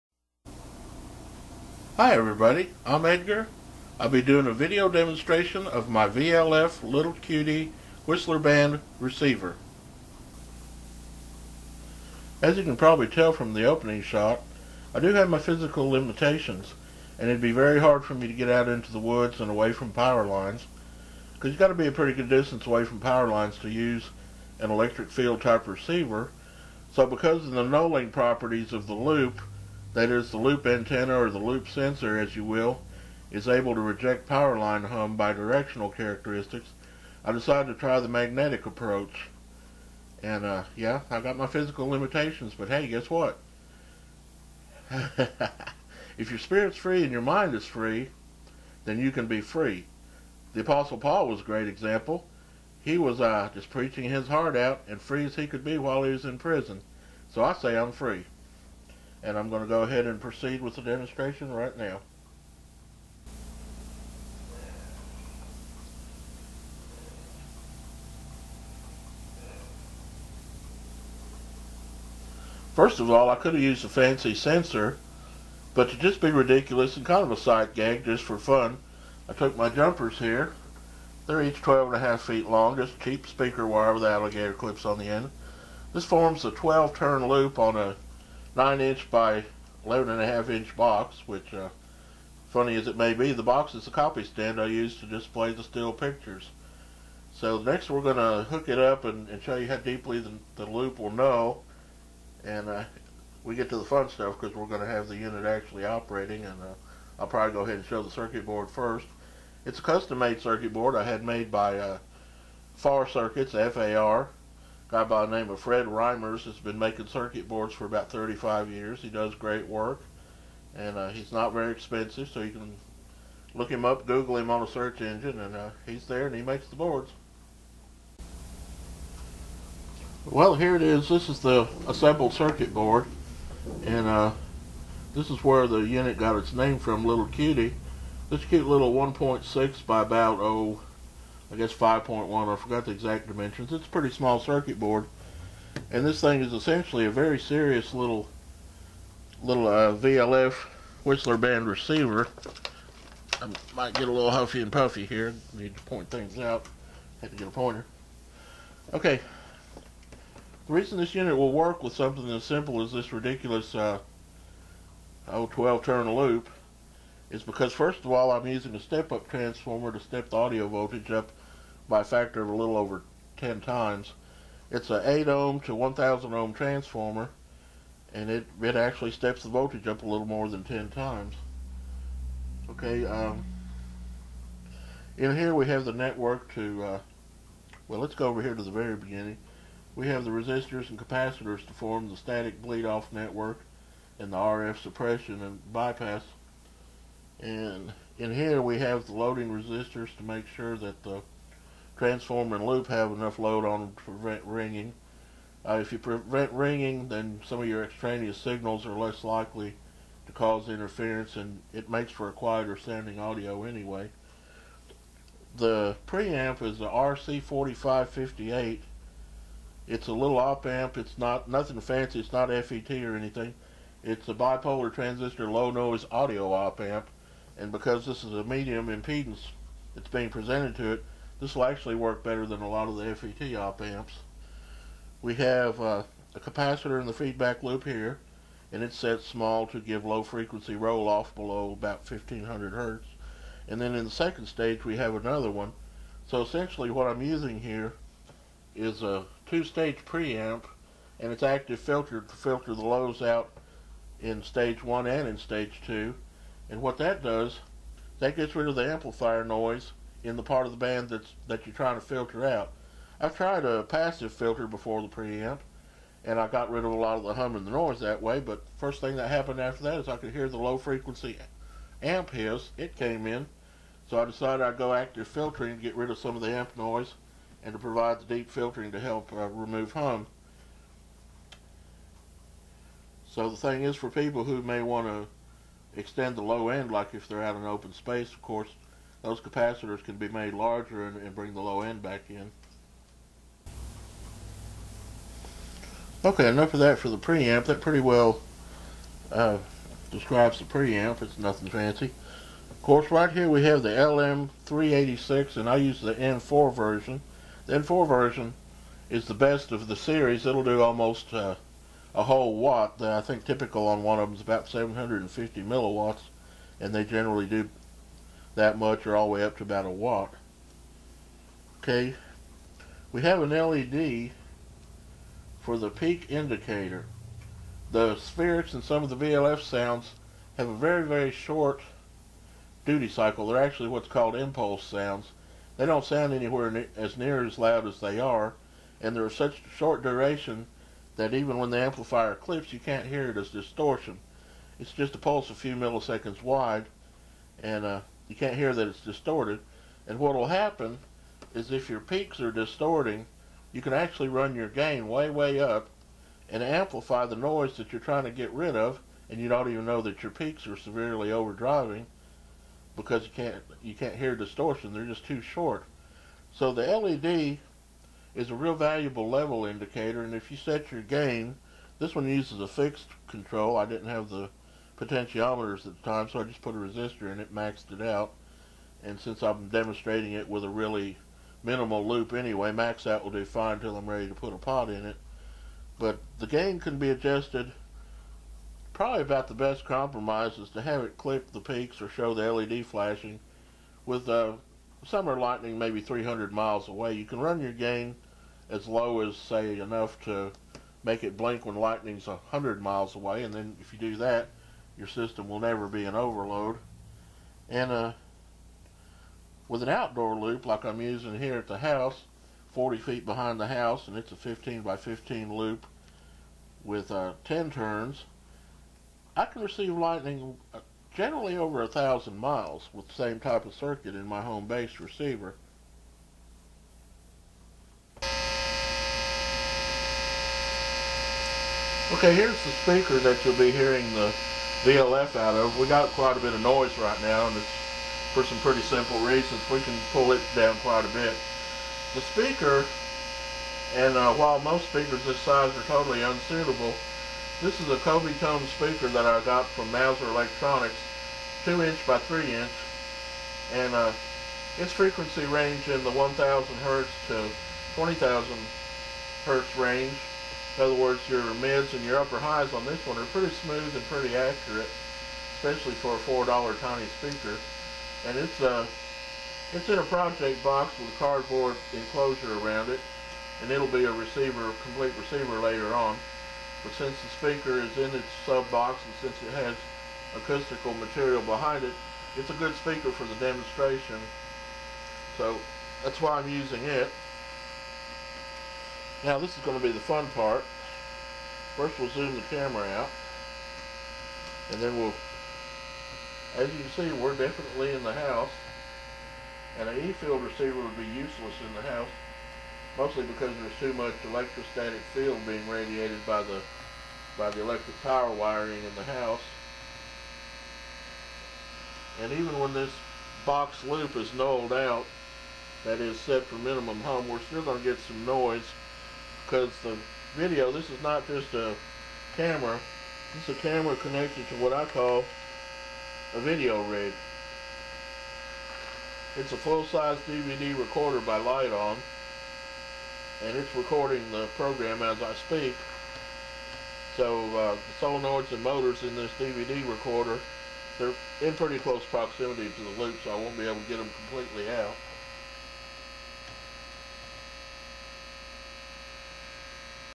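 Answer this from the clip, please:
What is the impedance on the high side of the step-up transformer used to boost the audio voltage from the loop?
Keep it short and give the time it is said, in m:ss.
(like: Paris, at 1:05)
1000 ohm, at 2:55.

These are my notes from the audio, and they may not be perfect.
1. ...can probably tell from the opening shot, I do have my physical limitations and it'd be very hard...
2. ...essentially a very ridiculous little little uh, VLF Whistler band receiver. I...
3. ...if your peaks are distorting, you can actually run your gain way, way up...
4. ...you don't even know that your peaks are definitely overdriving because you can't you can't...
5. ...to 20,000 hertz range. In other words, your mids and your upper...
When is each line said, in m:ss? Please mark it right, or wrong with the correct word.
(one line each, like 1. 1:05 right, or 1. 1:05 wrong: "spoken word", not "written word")
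1. 0:12 right
2. 2:26 wrong: "serious", not "ridiculous"
3. 5:51 right
4. 5:59 wrong: "severely", not "definitely"
5. 7:37 right.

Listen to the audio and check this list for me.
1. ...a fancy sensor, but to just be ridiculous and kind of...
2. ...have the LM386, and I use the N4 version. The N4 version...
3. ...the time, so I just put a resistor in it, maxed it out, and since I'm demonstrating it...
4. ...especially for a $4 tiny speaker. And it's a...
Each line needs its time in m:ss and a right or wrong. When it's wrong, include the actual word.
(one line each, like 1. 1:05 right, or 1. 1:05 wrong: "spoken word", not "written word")
1. 1:13 right
2. 5:03 right
3. 6:16 right
4. 7:45 right.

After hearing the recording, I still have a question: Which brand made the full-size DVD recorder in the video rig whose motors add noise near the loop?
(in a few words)
Lite-On.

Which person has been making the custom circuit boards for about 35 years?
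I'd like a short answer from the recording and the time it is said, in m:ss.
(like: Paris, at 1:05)
Fred Reimers, at 1:55.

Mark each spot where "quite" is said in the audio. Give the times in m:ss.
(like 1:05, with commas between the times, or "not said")
7:16, 7:20.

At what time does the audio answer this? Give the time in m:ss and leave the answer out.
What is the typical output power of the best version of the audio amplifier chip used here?
5:14.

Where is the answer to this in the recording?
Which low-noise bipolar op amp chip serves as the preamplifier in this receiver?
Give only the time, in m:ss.
3:36.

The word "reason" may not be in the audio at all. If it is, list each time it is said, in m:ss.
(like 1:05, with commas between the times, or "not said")
2:40, 7:19.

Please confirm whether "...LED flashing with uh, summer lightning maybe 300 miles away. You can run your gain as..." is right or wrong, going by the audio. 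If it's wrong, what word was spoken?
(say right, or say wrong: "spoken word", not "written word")
right.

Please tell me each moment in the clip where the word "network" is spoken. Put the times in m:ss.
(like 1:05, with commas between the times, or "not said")
3:05, 3:13.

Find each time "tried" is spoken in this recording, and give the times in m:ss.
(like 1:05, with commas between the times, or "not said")
4:23.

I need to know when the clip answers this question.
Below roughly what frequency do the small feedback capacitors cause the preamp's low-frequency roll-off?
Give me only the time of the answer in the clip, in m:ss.
4:02.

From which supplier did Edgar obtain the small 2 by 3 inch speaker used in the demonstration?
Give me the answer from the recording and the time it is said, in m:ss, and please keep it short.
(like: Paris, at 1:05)
Mouser Electronics, at 7:29.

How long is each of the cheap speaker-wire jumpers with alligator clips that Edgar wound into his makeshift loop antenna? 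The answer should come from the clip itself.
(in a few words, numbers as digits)
12.5 feet.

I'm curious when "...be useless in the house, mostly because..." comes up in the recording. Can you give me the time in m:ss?
8:20.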